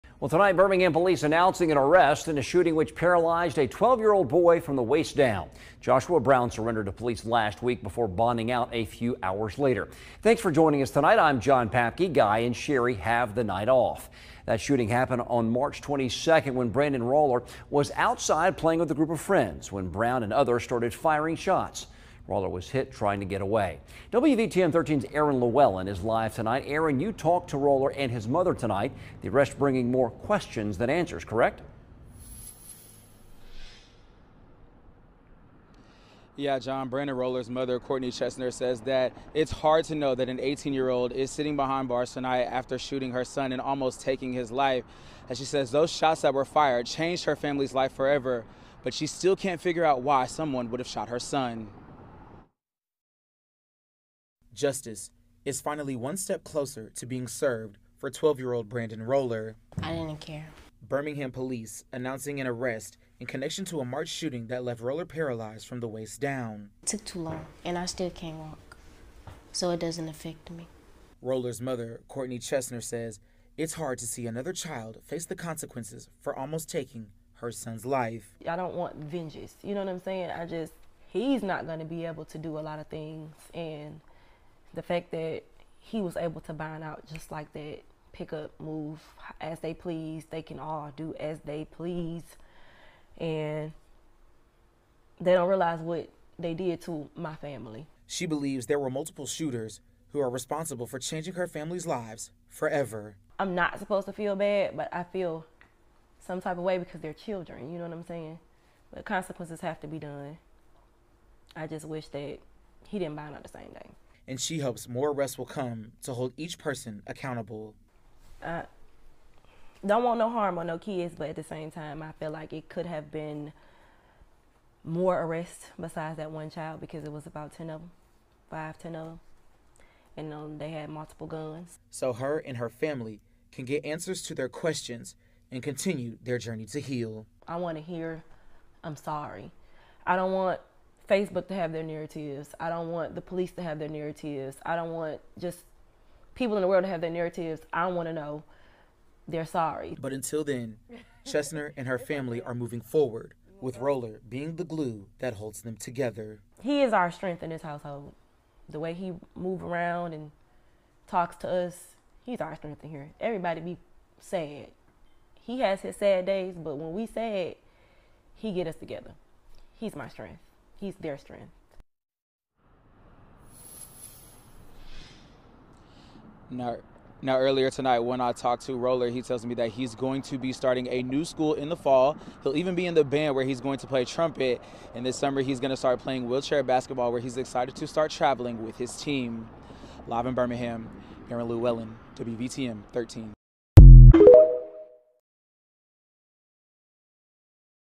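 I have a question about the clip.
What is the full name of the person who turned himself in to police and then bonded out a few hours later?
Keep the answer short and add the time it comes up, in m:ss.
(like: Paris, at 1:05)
Joshua Brown, at 0:05.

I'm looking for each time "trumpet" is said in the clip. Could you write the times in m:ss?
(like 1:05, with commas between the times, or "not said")
3:04.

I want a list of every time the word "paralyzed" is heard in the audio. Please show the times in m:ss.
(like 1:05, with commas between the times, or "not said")
0:02, 1:05.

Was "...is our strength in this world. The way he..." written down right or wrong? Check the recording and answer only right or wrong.
wrong.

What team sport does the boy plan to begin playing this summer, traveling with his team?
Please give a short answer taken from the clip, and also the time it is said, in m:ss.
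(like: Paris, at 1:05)
wheelchair basketball, at 3:06.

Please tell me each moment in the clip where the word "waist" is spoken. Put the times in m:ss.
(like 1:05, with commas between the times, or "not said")
0:04, 1:05.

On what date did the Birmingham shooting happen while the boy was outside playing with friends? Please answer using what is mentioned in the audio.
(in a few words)
March 22.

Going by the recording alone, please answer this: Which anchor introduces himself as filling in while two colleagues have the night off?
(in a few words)
John Papke.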